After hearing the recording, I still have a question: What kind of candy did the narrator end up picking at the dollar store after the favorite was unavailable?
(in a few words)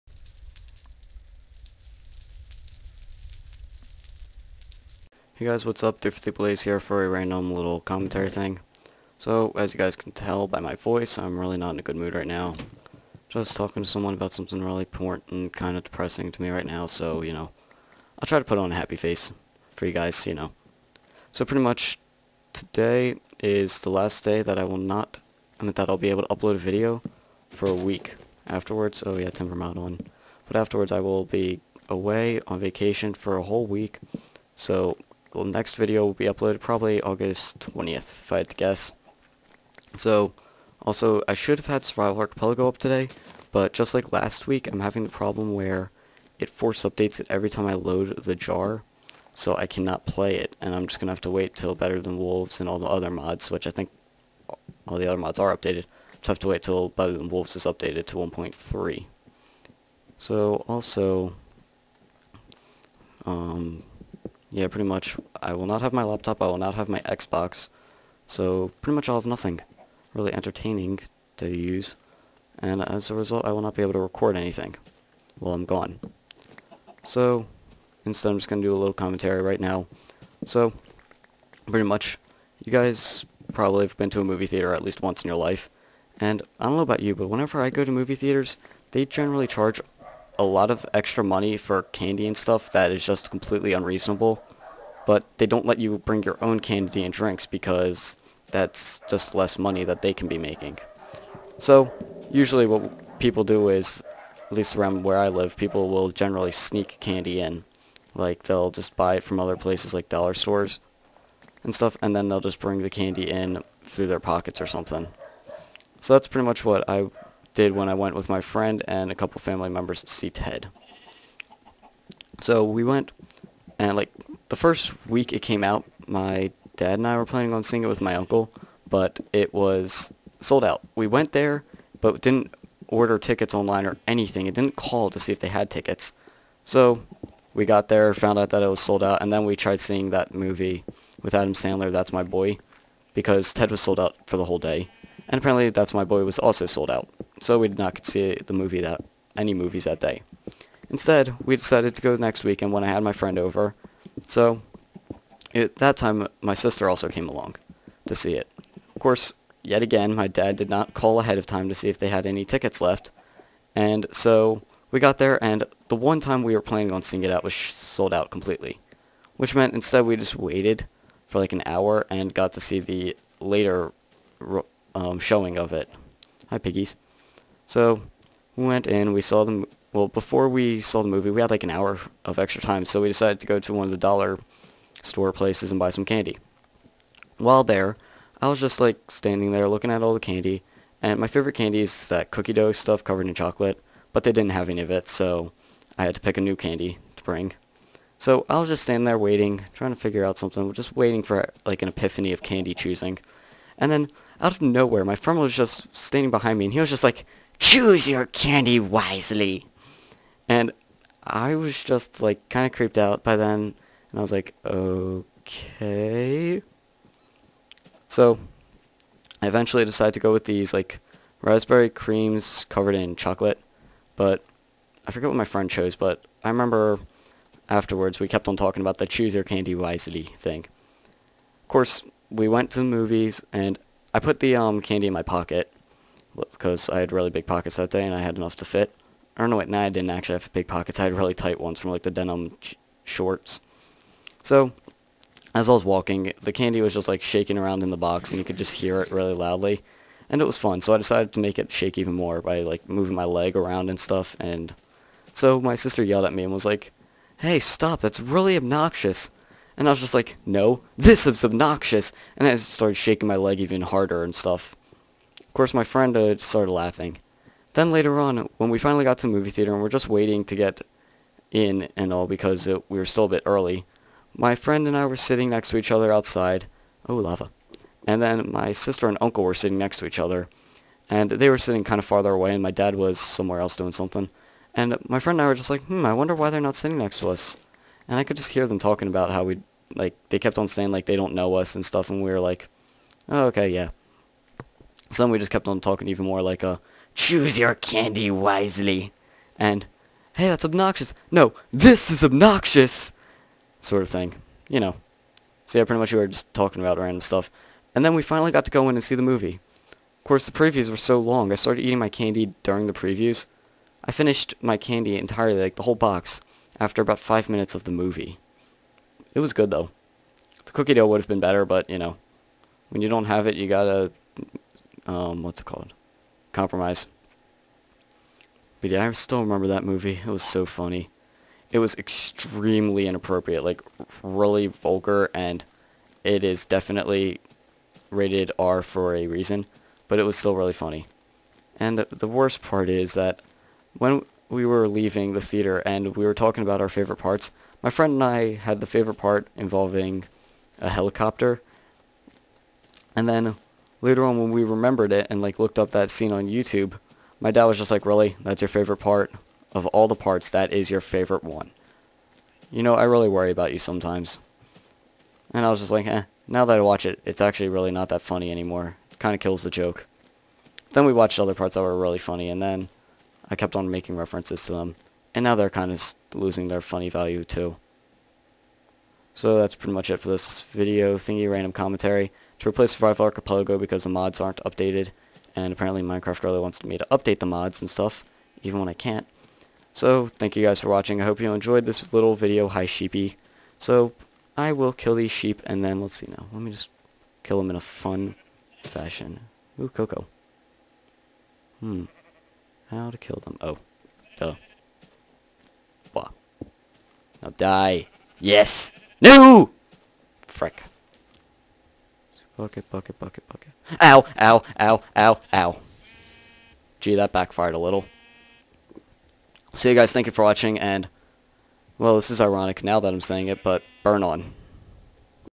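raspberry creams.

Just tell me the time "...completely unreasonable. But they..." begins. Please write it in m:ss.
1:33.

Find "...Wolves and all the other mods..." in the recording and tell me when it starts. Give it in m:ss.
0:52.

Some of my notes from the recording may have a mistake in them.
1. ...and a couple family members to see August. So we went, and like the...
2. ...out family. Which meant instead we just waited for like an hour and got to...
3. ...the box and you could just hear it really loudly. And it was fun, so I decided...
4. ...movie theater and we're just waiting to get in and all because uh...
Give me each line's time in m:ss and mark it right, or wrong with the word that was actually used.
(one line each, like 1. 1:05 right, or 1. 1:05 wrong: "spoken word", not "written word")
1. 1:58 wrong: "Ted", not "August"
2. 2:48 wrong: "completely", not "family"
3. 4:07 right
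4. 4:29 right.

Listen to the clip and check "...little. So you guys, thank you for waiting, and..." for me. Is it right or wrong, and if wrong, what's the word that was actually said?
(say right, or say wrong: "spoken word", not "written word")
wrong: "watching", not "waiting".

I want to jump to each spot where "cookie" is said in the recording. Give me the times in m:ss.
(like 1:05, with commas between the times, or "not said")
3:12, 5:20.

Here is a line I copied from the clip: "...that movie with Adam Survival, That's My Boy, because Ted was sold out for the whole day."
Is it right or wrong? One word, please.
wrong.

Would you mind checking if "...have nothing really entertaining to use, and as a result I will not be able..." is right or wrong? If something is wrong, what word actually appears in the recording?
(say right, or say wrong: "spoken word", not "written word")
right.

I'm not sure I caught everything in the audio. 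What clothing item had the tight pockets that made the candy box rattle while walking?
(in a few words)
denim shorts.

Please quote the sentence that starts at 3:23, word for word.
And then out of nowhere, my friend was just standing behind me, and he was just like, Choose your candy wisely.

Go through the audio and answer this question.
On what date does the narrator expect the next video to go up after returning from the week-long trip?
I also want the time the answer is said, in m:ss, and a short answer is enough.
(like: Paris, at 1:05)
August 20th, at 0:37.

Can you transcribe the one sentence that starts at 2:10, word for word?
We went there, but didn't order tickets online or anything.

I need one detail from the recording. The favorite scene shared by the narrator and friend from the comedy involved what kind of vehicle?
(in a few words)
helicopter.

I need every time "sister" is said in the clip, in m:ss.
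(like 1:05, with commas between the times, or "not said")
2:36, 4:15, 4:38.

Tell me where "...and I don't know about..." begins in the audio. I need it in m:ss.
1:26.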